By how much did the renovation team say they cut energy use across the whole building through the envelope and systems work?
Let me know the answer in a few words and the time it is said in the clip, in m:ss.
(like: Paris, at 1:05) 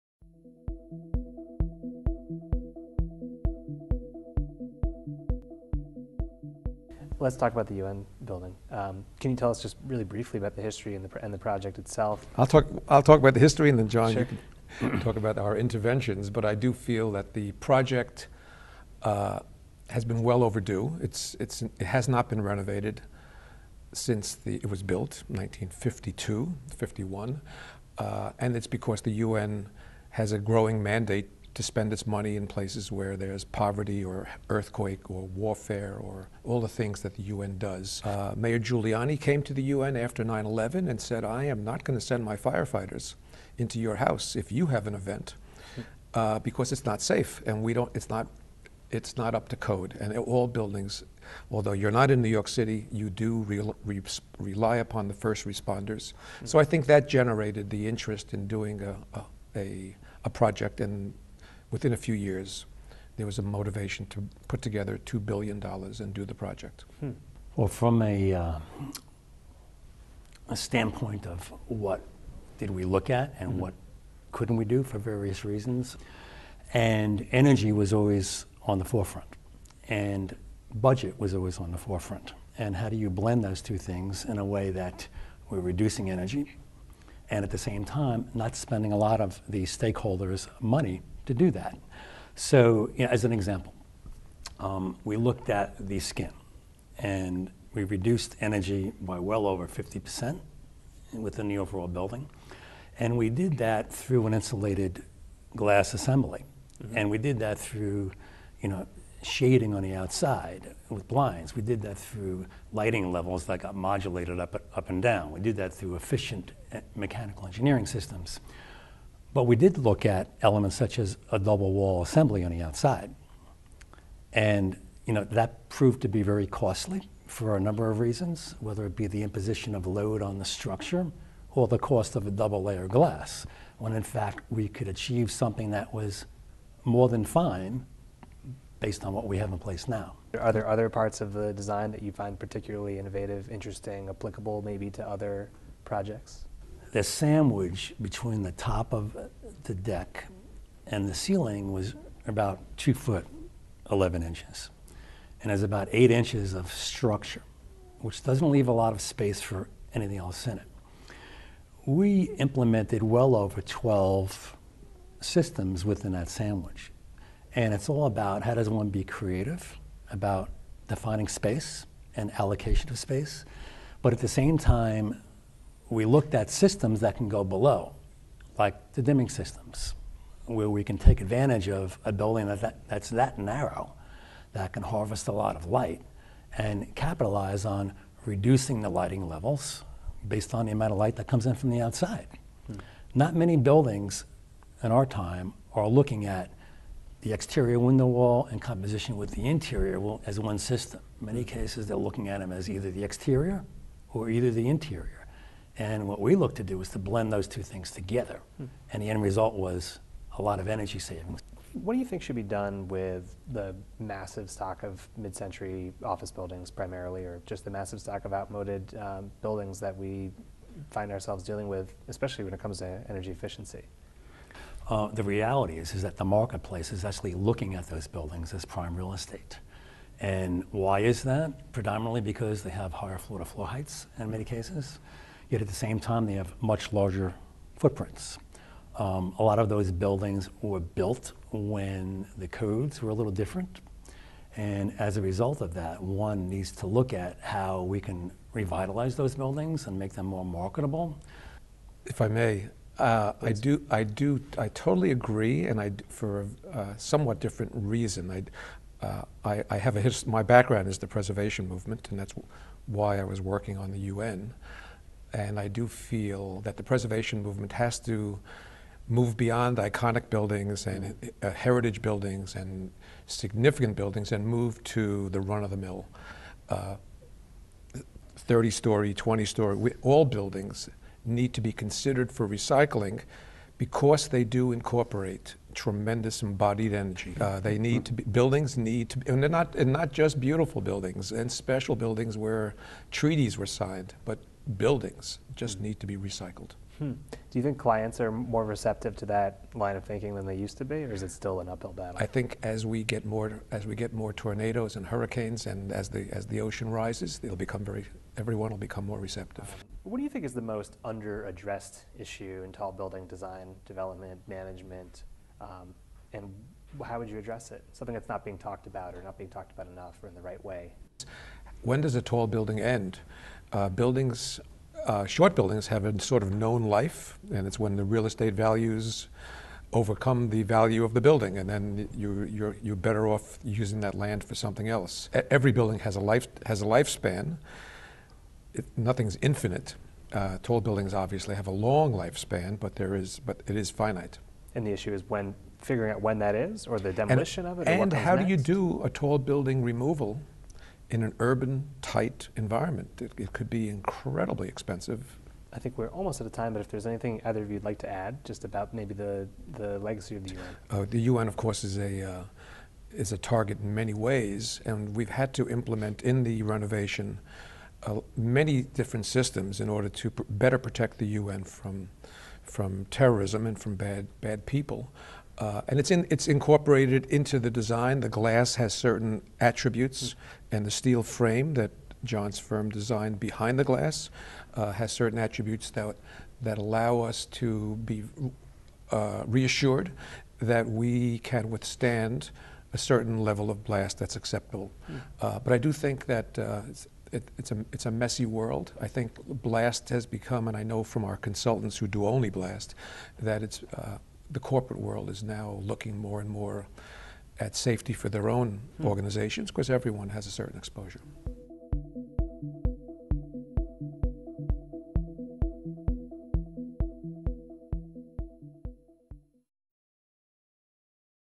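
over 50%, at 1:39.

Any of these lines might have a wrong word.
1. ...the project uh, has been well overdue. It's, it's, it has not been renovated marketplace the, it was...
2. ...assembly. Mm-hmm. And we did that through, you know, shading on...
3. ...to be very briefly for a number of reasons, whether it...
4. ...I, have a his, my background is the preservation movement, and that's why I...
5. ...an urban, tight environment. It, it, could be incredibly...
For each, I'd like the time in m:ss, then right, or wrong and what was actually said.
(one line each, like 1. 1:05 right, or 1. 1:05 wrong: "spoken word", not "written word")
1. 0:17 wrong: "since", not "marketplace"
2. 1:45 right
3. 2:06 wrong: "costly", not "briefly"
4. 4:19 right
5. 5:51 right.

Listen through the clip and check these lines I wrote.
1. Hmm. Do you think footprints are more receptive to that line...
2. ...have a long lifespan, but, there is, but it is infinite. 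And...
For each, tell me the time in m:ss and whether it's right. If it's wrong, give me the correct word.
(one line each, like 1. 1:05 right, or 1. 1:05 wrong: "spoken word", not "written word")
1. 4:56 wrong: "clients", not "footprints"
2. 5:41 wrong: "finite", not "infinite".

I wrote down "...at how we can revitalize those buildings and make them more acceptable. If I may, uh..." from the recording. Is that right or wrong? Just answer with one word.
wrong.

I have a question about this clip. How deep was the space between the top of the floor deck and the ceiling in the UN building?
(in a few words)
2 feet 11 inches.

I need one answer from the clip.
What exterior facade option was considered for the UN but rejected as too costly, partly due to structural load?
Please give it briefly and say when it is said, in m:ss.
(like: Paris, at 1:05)
double wall assembly, at 2:01.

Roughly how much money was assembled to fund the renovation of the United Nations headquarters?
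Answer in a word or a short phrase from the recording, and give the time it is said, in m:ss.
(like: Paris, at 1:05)
$2 billion, at 1:05.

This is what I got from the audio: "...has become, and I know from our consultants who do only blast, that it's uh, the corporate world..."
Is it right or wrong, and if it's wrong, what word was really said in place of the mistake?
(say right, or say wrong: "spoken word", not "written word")
right.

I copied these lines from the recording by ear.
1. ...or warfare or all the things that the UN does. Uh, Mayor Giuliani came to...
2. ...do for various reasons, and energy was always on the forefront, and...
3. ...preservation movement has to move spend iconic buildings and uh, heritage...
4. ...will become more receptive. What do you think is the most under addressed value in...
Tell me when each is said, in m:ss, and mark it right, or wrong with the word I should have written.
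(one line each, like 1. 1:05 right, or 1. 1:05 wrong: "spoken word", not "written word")
1. 0:35 right
2. 1:14 right
3. 4:26 wrong: "beyond", not "spend"
4. 5:08 wrong: "issue", not "value".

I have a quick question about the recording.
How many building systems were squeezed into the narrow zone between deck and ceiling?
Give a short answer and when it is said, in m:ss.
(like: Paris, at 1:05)
over 12, at 2:43.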